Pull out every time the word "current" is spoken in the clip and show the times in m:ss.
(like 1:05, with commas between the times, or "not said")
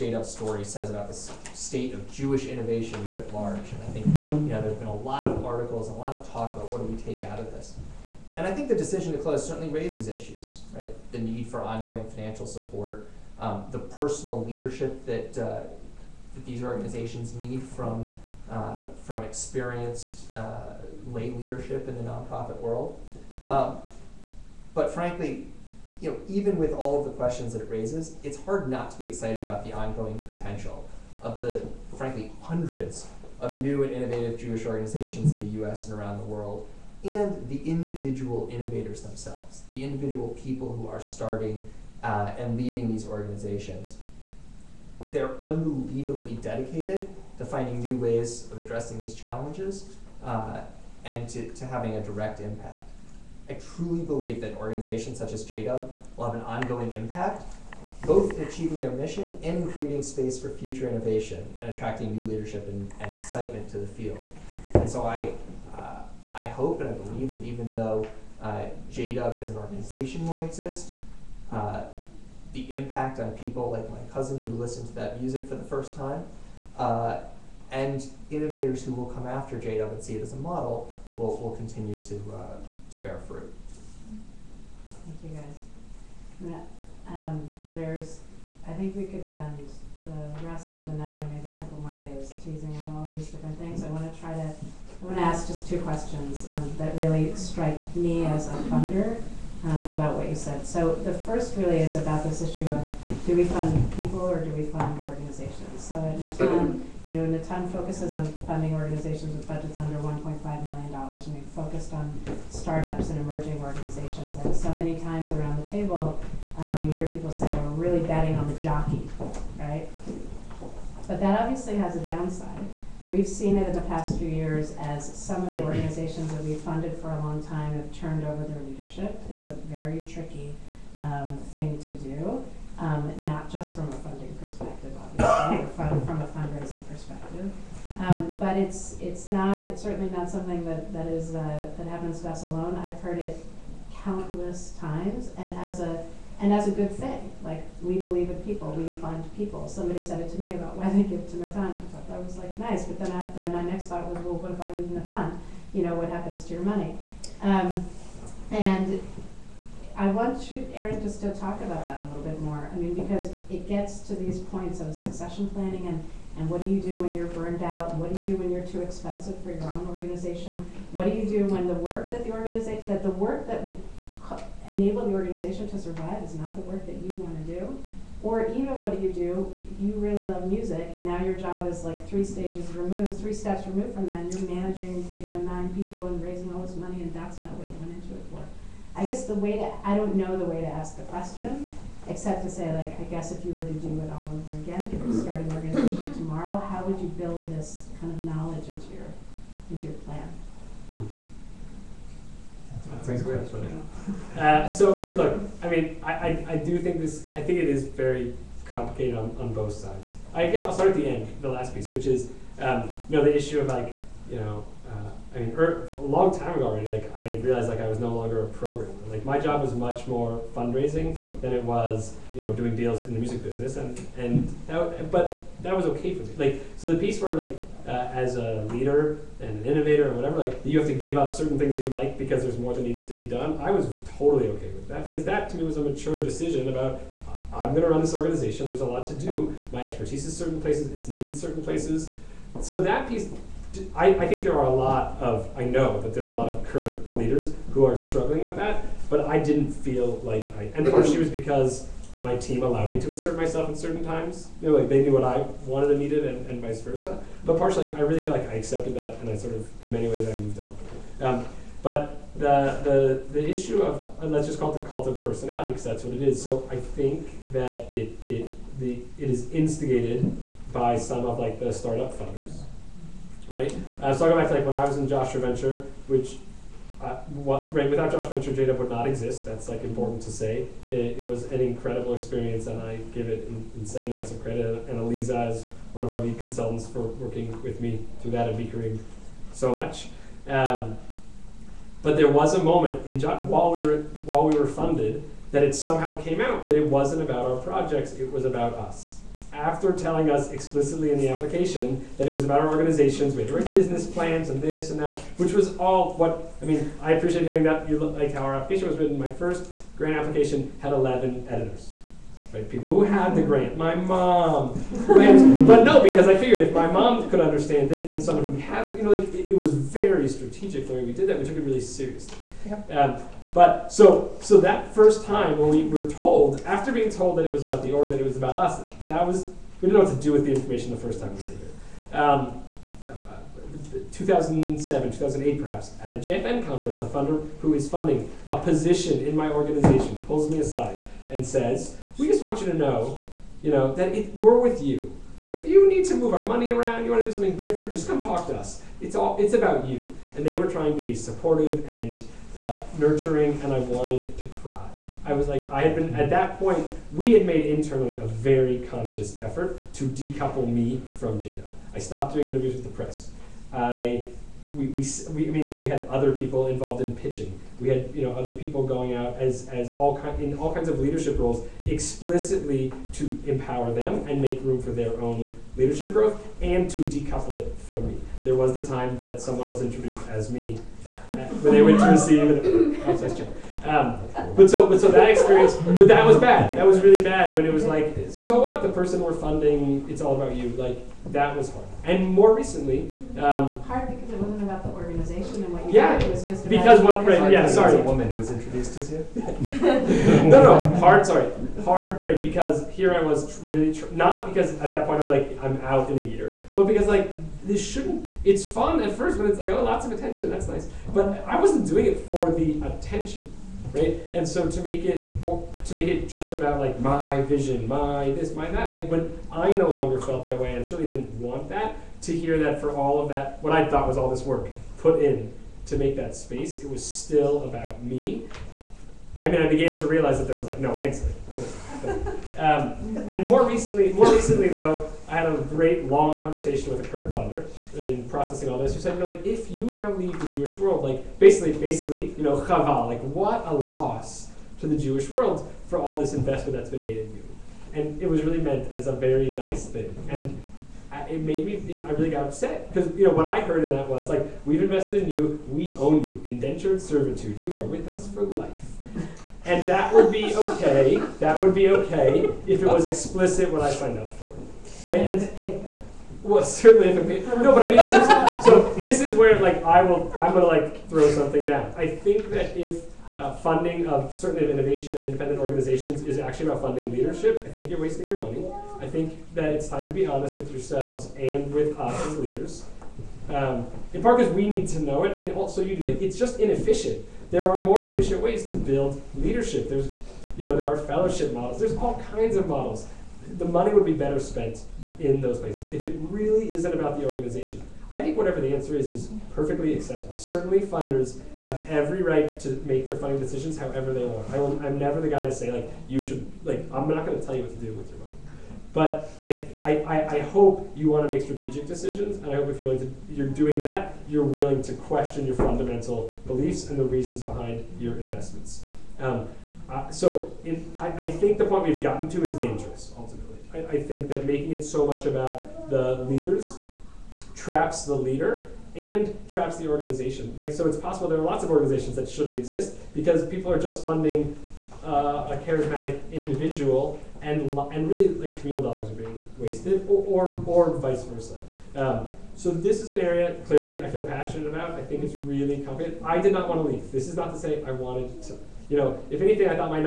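4:06, 7:17.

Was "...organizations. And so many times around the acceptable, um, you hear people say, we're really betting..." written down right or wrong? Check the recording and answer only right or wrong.
wrong.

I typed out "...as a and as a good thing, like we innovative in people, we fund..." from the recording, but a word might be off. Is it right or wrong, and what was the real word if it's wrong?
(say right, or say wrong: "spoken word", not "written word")
wrong: "believe", not "innovative".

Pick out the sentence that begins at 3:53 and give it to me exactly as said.
I was totally okay with that because that to me was a mature decision about I'm going to run this organization.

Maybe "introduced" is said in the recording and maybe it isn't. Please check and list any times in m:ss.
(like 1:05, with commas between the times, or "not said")
6:19, 6:38.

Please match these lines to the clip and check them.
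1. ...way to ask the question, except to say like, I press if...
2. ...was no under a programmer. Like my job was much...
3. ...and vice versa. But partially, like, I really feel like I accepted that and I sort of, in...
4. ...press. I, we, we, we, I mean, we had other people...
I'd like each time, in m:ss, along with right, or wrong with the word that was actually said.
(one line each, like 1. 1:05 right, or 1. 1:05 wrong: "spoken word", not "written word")
1. 3:10 wrong: "guess", not "press"
2. 3:37 wrong: "longer", not "under"
3. 4:16 right
4. 6:02 right.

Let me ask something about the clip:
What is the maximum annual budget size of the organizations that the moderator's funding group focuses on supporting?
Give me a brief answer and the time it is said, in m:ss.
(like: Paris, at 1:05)
$1.5 million, at 1:49.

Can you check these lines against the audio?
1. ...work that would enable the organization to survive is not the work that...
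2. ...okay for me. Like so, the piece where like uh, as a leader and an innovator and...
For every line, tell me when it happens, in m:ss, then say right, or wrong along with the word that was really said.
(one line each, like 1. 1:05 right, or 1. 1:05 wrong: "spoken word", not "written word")
1. 2:53 right
2. 3:45 right.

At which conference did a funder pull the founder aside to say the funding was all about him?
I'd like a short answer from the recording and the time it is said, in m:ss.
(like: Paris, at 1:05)
JFN conference, at 5:36.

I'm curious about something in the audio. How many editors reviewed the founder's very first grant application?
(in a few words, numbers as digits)
11.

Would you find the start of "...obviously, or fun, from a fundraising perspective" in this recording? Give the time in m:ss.
2:14.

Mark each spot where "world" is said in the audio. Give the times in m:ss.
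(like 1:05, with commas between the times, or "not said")
0:22, 0:36, 7:20, 7:25.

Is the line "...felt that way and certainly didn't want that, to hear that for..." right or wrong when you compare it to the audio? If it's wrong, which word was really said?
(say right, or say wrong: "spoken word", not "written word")
right.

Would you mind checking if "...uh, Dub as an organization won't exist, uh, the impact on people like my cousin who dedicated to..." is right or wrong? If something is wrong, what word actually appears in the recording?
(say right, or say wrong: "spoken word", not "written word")
wrong: "listened", not "dedicated".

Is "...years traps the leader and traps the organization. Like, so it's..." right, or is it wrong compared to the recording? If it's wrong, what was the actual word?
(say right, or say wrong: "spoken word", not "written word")
wrong: "leaders", not "years".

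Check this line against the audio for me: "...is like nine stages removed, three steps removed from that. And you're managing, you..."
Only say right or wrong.
wrong.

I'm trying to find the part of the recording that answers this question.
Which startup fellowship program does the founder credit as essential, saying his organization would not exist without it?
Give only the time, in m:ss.
4:35.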